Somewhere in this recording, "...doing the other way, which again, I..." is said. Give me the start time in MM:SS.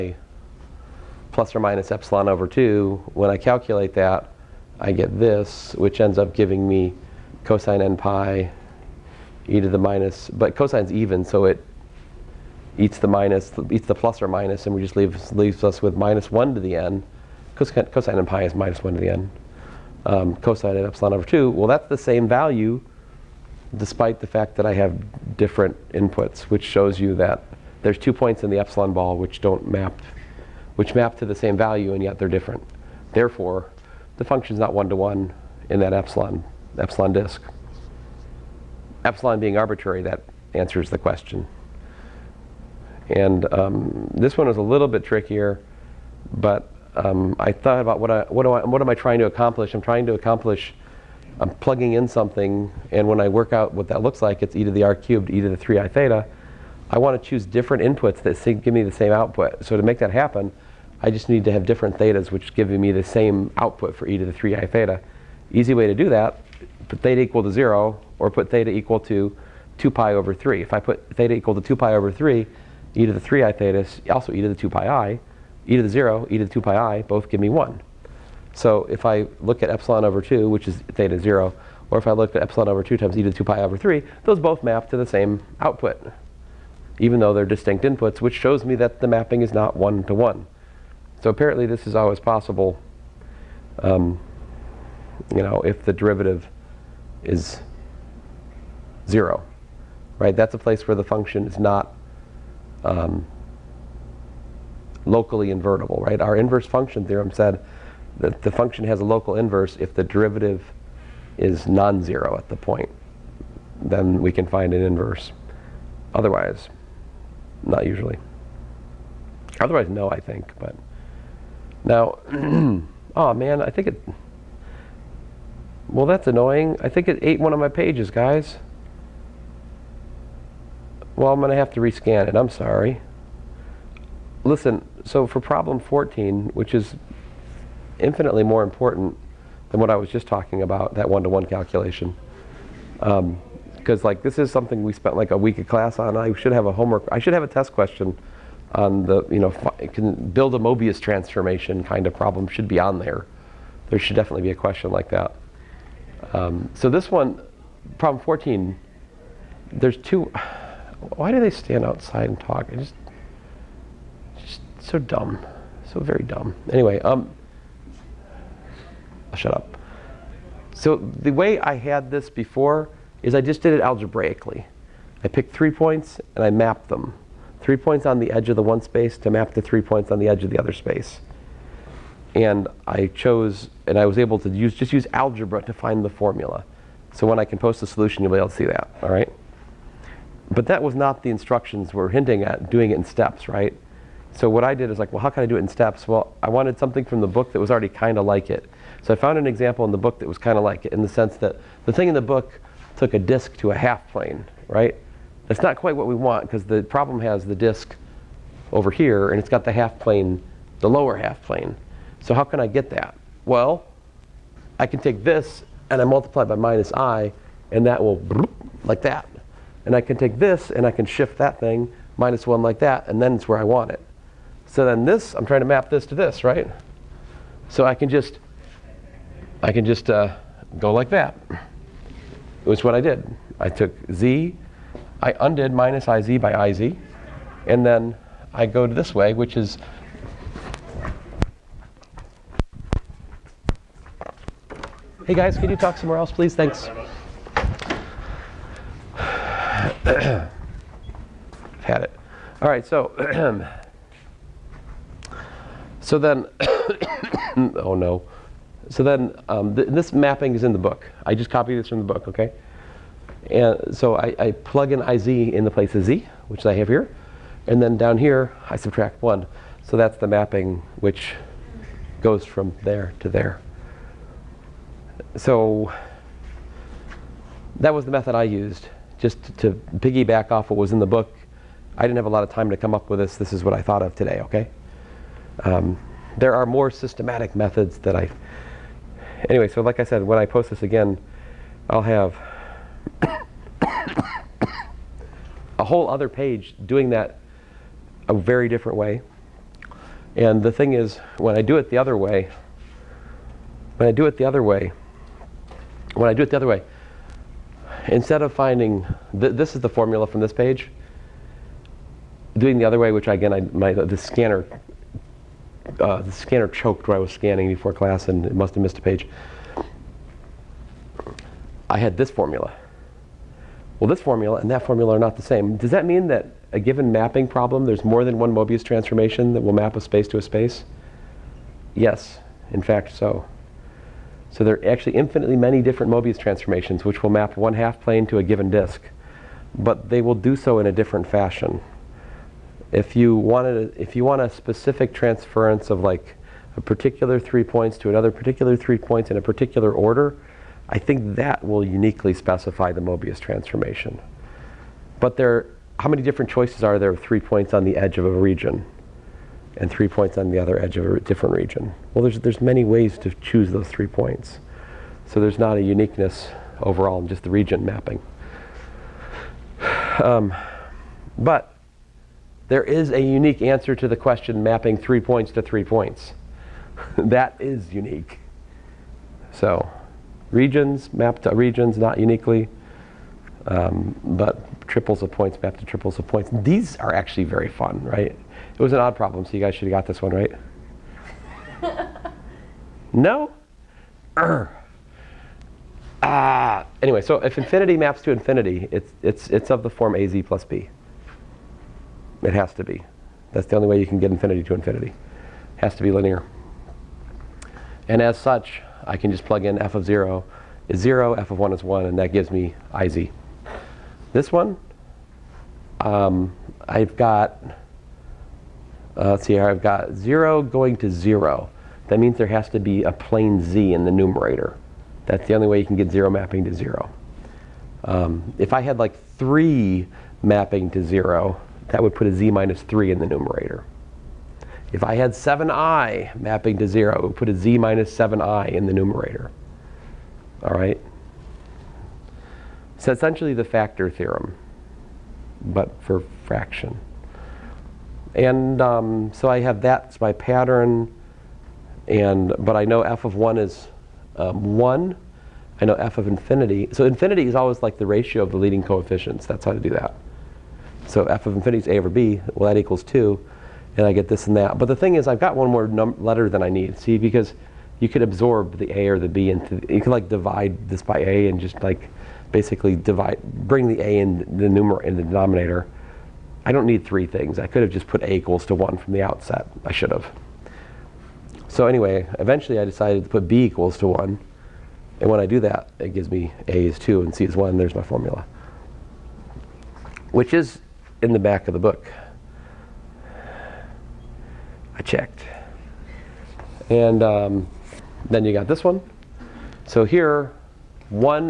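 05:12.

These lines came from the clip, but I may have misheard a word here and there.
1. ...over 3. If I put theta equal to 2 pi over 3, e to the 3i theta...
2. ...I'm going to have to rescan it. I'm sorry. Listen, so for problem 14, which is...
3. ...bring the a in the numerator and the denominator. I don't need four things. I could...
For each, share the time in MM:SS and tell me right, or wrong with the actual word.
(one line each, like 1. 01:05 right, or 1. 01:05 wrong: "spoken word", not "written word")
1. 01:10 right
2. 02:11 right
3. 07:53 wrong: "three", not "four".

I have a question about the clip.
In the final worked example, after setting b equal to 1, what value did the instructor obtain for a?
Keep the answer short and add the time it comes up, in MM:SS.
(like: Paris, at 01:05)
2, at 08:06.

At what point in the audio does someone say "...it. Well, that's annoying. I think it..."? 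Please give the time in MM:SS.
02:03.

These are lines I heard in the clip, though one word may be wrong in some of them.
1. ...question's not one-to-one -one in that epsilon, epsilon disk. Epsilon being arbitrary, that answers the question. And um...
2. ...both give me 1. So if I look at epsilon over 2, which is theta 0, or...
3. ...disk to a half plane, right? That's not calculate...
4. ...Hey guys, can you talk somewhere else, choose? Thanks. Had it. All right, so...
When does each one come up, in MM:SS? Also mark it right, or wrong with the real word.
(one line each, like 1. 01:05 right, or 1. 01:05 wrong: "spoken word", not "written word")
1. 00:34 wrong: "function", not "question"
2. 01:17 right
3. 03:23 wrong: "quite", not "calculate"
4. 04:05 wrong: "please", not "choose".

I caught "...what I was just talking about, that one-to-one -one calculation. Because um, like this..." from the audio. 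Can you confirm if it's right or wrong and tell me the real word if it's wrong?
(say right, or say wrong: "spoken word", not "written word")
right.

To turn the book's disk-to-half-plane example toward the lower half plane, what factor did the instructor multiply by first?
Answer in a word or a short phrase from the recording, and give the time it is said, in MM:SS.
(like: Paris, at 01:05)
minus i, at 03:36.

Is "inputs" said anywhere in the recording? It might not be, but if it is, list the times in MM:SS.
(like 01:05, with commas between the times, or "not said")
00:25, 00:57, 01:27.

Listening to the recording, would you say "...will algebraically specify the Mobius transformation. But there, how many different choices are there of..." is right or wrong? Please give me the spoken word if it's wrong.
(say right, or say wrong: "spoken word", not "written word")
wrong: "uniquely", not "algebraically".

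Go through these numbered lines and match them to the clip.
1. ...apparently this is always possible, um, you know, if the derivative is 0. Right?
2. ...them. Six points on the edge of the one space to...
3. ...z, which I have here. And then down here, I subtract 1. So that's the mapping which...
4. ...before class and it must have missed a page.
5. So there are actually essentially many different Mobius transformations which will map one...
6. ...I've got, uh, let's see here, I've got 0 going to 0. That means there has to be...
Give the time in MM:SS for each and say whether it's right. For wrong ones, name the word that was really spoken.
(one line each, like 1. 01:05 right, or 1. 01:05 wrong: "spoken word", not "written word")
1. 01:31 right
2. 02:56 wrong: "Three", not "Six"
3. 04:26 right
4. 05:17 right
5. 05:34 wrong: "infinitely", not "essentially"
6. 06:56 right.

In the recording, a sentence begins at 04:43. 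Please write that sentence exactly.
This is what I thought of today, okay?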